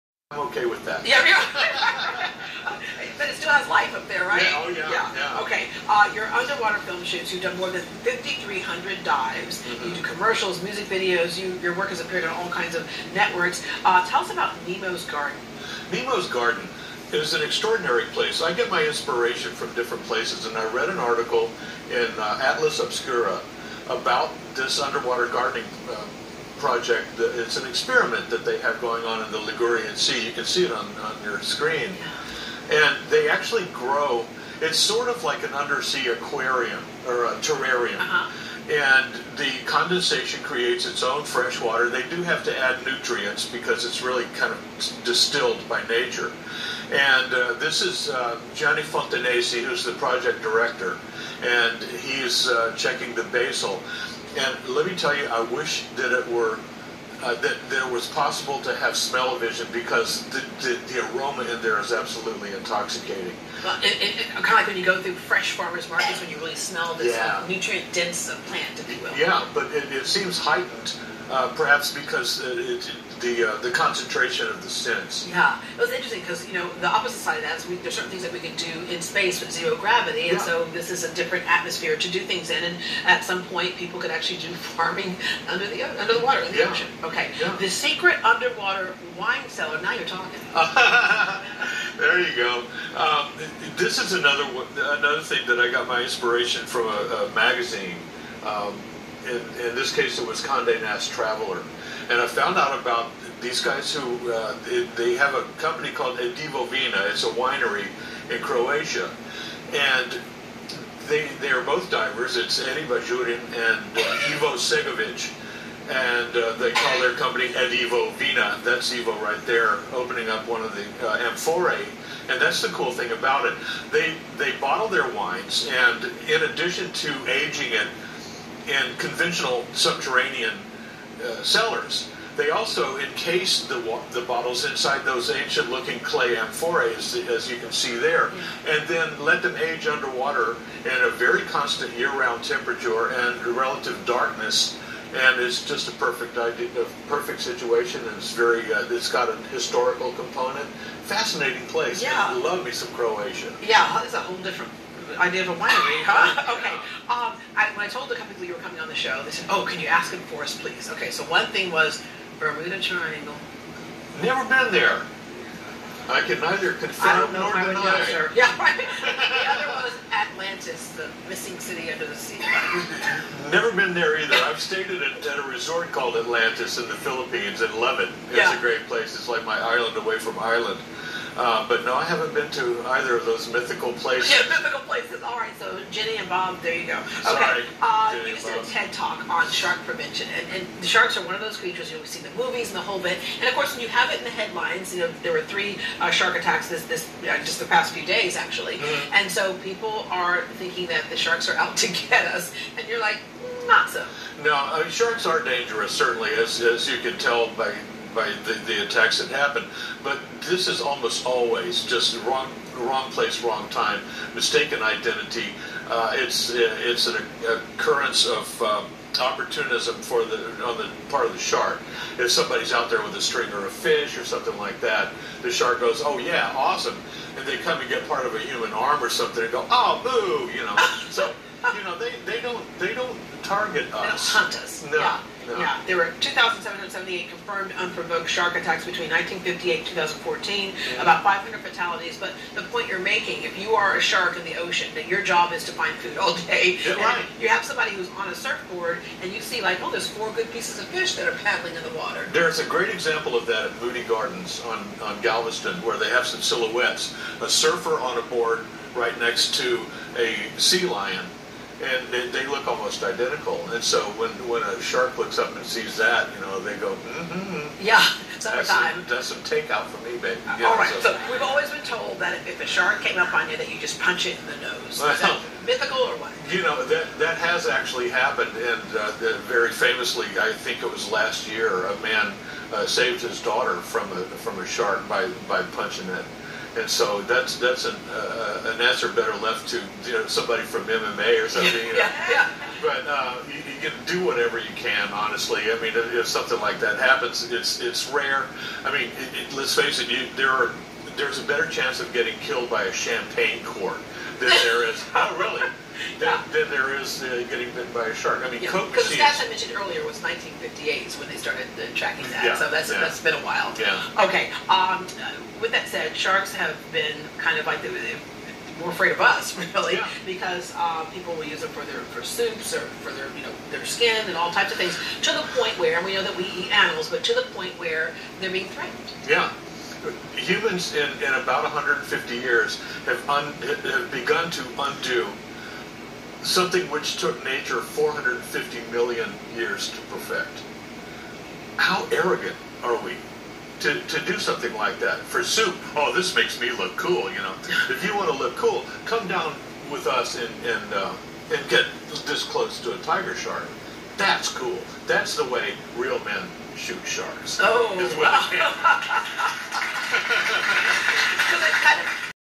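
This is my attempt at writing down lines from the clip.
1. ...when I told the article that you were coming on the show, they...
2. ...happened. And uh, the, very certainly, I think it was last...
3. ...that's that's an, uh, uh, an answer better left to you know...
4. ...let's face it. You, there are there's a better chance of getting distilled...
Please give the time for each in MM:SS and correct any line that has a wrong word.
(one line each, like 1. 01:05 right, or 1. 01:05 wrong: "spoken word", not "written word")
1. 02:37 wrong: "couple", not "article"
2. 04:38 wrong: "famously", not "certainly"
3. 04:47 right
4. 04:59 wrong: "killed", not "distilled".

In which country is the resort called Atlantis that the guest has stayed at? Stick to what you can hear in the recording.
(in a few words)
Philippines.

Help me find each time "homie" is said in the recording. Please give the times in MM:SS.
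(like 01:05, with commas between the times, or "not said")
not said.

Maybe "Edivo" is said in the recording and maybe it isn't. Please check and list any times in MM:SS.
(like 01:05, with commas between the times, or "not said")
01:46, 01:57.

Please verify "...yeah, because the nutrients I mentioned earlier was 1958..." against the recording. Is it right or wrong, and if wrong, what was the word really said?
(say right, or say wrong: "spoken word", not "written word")
wrong: "stats", not "nutrients".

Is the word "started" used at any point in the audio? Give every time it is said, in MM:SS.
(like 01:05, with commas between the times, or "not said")
05:11.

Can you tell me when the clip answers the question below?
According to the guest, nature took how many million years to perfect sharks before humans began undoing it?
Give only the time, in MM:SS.
05:37.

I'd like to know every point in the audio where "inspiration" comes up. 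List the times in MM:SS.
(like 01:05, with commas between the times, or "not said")
00:18, 01:36.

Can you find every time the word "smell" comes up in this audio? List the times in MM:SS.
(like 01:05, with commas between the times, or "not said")
00:58, 01:06.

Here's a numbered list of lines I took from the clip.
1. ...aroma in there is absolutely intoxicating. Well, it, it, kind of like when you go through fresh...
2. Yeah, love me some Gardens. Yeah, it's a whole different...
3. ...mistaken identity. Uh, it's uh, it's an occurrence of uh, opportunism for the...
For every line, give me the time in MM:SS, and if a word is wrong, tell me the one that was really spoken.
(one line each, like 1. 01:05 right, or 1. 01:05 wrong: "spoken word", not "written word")
1. 01:01 right
2. 02:32 wrong: "Croatia", not "Gardens"
3. 03:34 right.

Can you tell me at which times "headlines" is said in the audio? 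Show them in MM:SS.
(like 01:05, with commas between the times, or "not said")
03:14.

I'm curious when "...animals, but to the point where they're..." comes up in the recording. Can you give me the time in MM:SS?
05:26.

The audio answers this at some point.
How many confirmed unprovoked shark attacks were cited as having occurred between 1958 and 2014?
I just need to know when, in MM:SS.
03:56.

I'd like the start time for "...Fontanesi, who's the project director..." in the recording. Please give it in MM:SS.
00:48.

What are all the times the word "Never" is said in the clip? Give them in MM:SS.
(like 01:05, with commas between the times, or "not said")
02:44, 02:53.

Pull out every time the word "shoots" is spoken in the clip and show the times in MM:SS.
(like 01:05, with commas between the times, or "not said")
00:07, 05:56.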